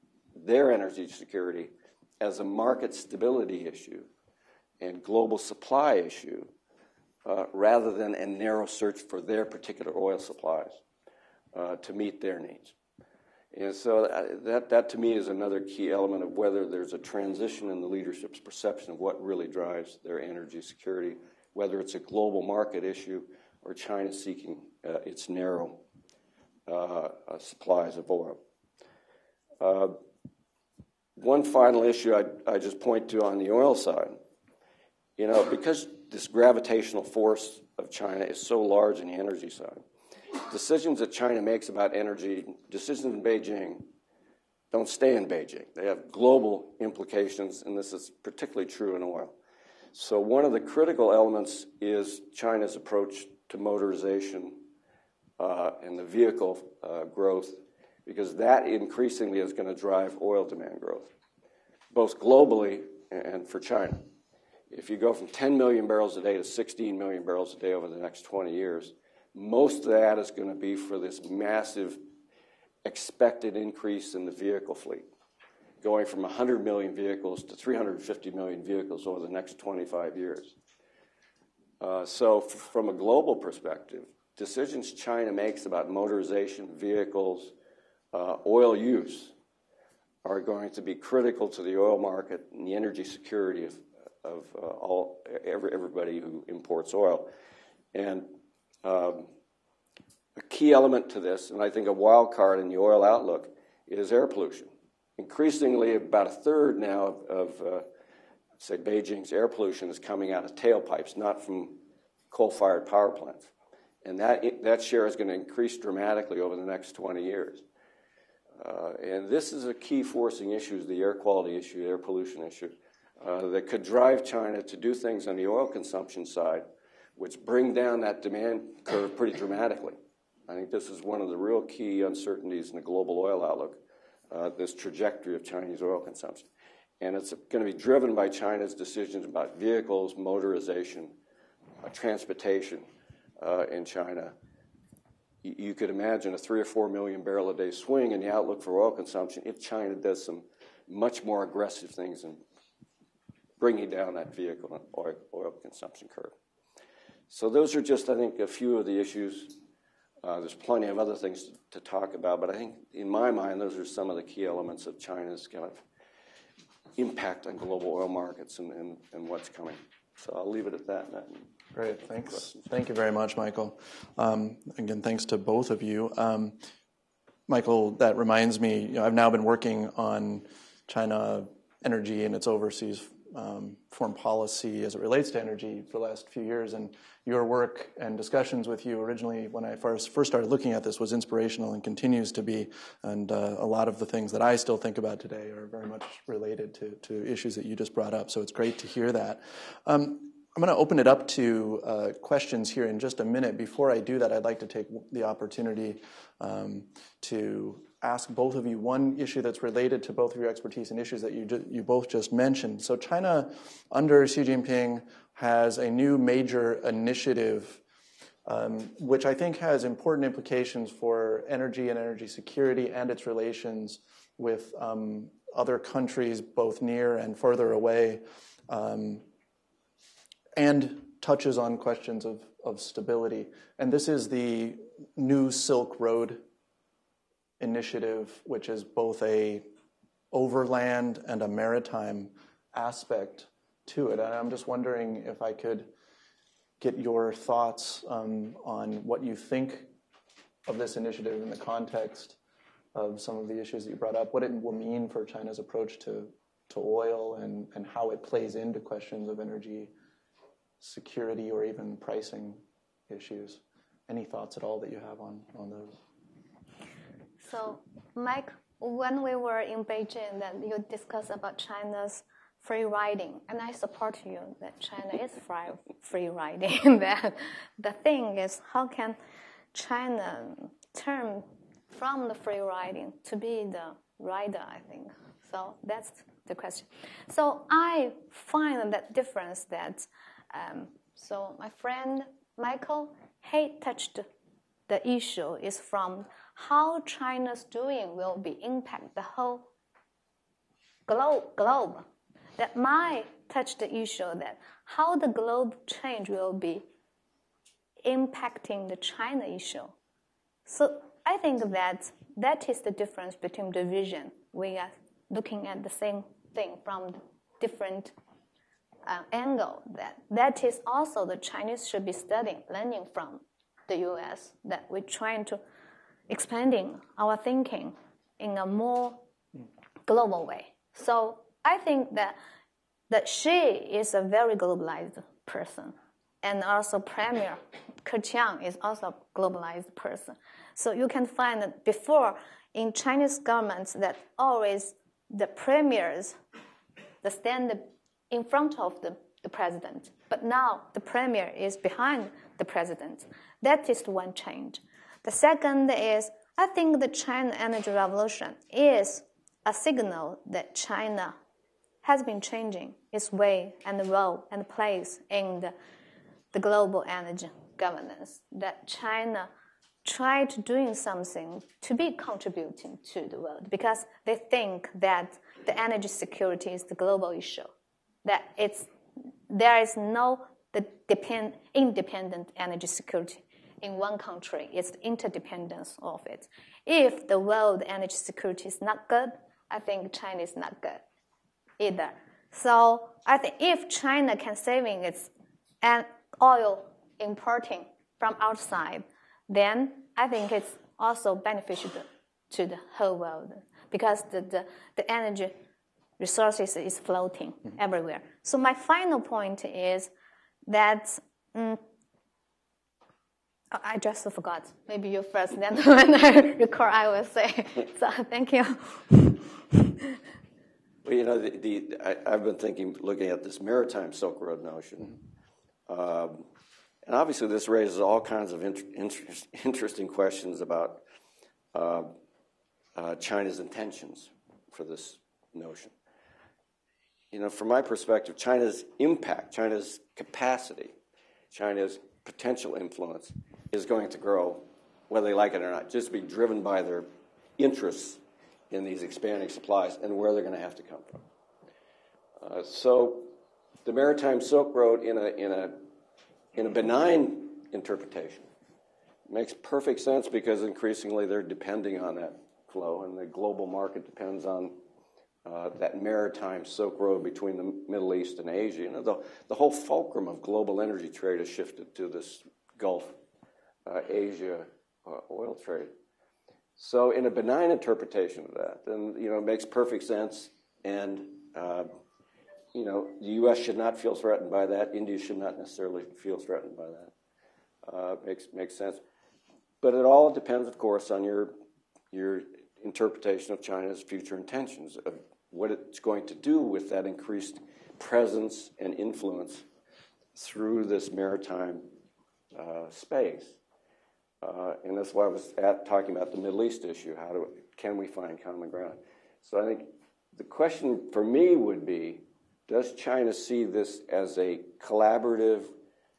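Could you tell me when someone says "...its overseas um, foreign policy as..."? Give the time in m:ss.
3:02.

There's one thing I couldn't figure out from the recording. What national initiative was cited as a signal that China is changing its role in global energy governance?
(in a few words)
China Energy Revolution.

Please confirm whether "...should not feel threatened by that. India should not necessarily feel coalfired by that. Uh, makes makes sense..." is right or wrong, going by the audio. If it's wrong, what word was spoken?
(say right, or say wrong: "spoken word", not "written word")
wrong: "threatened", not "coalfired".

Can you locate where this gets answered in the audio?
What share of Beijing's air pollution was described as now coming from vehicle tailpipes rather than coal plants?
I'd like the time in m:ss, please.
1:45.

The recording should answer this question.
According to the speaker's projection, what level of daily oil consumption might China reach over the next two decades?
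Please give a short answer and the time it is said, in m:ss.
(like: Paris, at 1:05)
16 million barrels a day, at 1:06.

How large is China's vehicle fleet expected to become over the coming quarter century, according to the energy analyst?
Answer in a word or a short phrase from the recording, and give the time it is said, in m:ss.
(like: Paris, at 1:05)
350 million vehicles, at 1:17.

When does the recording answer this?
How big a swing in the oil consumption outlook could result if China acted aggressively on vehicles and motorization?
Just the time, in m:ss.
2:26.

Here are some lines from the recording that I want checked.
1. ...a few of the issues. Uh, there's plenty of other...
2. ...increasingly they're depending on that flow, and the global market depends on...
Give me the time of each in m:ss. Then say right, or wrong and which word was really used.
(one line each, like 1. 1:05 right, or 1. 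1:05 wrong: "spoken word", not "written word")
1. 2:38 right
2. 7:40 right.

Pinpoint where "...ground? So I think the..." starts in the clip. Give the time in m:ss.
8:28.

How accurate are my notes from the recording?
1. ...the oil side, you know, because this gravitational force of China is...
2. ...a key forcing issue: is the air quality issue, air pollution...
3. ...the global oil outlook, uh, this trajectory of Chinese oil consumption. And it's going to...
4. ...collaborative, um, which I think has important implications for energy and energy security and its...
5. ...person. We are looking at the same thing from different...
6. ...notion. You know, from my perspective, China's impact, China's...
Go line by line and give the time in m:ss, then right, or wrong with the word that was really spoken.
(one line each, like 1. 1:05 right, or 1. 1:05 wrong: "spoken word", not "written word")
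1. 0:33 right
2. 1:59 right
3. 2:12 right
4. 3:36 wrong: "initiative", not "collaborative"
5. 5:13 wrong: "vision", not "person"
6. 7:15 right.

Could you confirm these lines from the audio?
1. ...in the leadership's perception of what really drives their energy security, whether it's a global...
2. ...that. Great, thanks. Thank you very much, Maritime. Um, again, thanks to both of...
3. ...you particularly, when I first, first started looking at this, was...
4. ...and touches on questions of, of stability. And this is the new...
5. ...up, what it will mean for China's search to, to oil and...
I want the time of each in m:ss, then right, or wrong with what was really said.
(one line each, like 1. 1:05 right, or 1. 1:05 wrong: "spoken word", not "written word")
1. 0:17 right
2. 2:50 wrong: "Mikkal", not "Maritime"
3. 3:08 wrong: "originally", not "particularly"
4. 3:50 right
5. 4:14 wrong: "approach", not "search".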